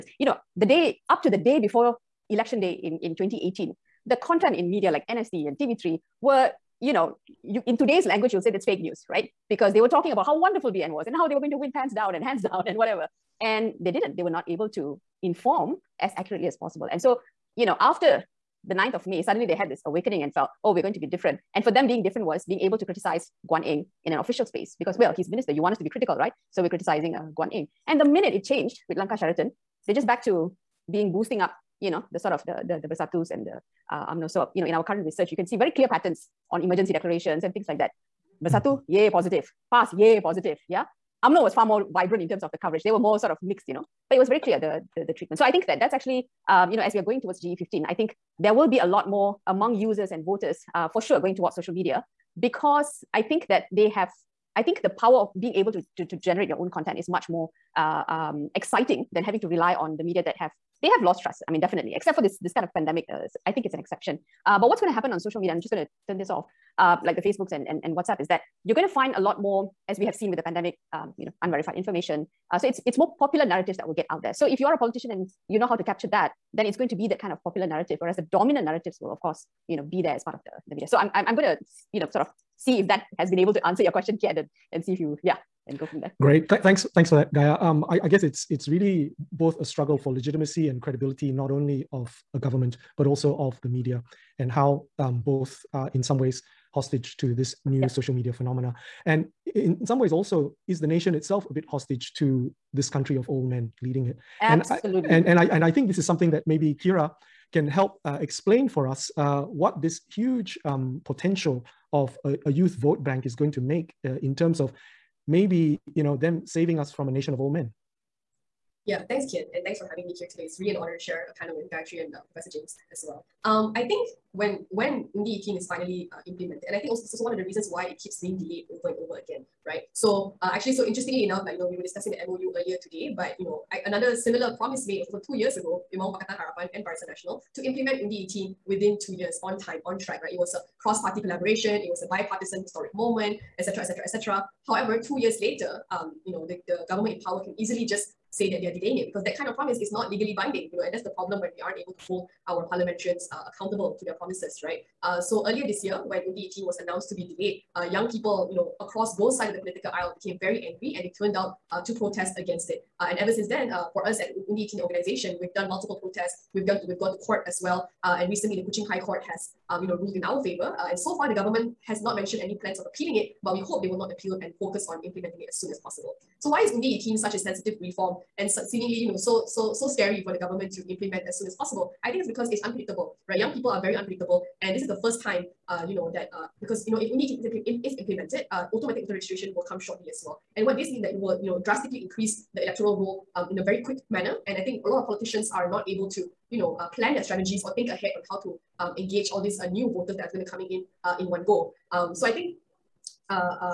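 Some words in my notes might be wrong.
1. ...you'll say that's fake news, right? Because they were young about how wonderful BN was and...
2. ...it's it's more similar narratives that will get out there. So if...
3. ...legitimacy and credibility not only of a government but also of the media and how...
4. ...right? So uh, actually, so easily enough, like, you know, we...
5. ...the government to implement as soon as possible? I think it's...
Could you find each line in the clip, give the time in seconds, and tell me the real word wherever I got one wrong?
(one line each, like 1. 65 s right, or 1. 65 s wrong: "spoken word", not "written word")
1. 8 s wrong: "talking", not "young"
2. 72 s wrong: "popular", not "similar"
3. 90 s right
4. 129 s wrong: "interestingly", not "easily"
5. 180 s right.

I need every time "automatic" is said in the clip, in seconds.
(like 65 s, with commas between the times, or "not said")
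188 s.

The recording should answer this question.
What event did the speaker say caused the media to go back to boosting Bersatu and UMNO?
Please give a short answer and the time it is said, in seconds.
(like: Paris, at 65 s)
Langkah Sheraton, at 28 s.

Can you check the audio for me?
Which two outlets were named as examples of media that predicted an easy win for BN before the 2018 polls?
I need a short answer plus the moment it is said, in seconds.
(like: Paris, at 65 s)
NST and TV3, at 5 s.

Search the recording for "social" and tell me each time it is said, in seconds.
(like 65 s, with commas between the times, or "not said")
51 s, 65 s, 97 s.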